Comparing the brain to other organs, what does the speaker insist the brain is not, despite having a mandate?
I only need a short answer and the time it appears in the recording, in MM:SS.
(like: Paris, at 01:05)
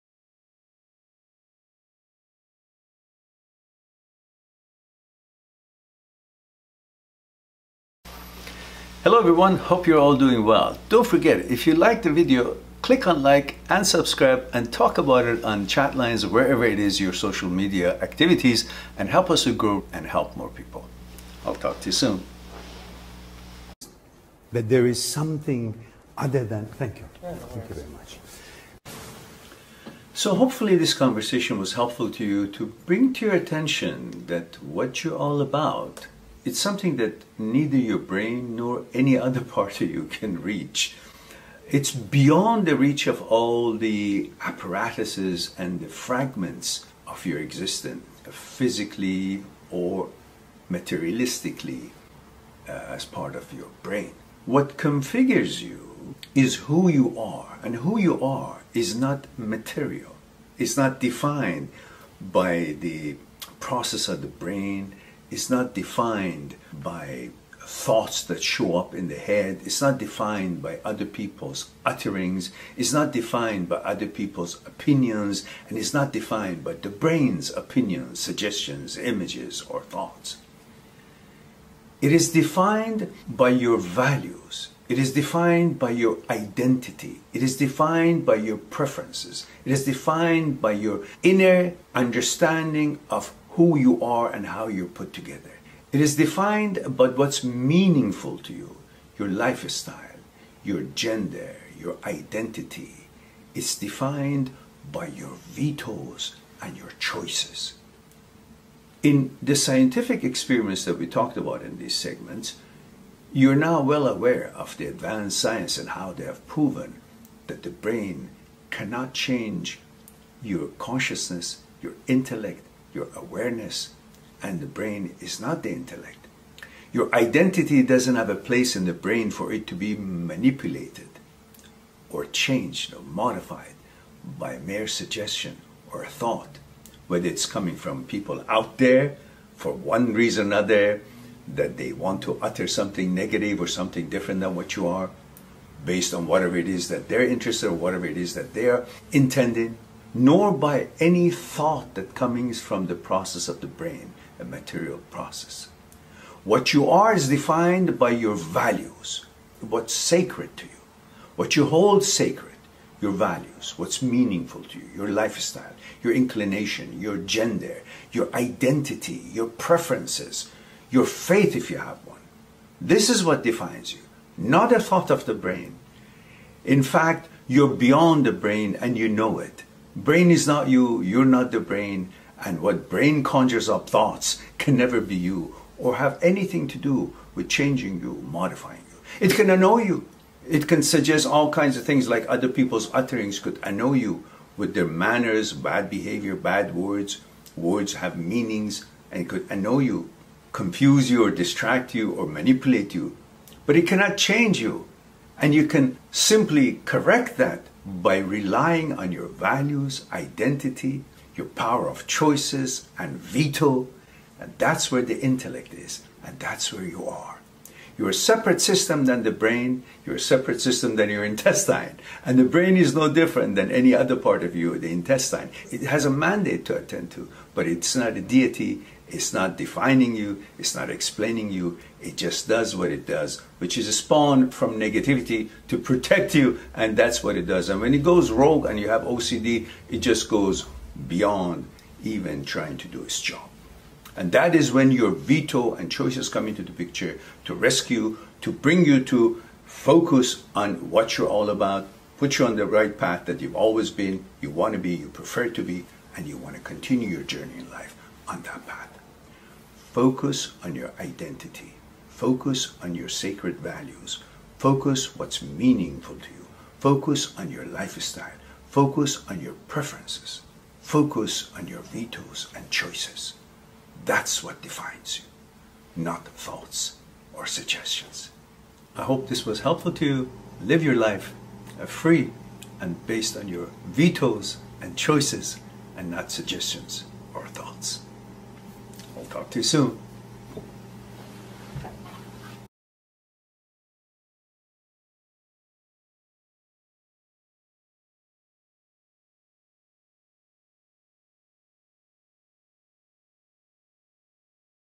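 a deity, at 03:48.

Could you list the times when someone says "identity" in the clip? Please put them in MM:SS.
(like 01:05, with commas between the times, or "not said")
01:26, 01:42, 02:07, 02:48, 03:30, 04:20.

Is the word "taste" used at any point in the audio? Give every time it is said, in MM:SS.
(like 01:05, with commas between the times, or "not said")
not said.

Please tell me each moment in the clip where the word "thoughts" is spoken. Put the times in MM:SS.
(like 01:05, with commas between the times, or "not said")
01:07, 01:19, 02:16, 02:31, 02:54, 03:03, 04:36, 04:47.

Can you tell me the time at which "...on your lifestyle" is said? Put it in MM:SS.
04:27.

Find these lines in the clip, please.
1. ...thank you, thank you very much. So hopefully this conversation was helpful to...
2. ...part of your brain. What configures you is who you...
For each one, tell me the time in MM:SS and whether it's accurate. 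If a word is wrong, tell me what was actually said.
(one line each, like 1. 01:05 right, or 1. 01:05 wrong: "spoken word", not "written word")
1. 00:26 right
2. 00:53 right.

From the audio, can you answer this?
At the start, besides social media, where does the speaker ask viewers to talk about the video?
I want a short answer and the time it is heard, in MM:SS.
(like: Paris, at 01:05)
chat lines, at 00:15.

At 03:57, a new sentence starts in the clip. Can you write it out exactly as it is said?
And when it goes rogue and you have OCD, it just goes beyond even trying to do its job.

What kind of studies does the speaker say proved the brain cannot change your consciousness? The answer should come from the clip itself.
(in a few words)
scientific experiments.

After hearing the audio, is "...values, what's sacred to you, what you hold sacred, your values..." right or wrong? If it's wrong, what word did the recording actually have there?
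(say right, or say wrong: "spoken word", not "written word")
right.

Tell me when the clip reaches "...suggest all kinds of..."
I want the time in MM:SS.
03:10.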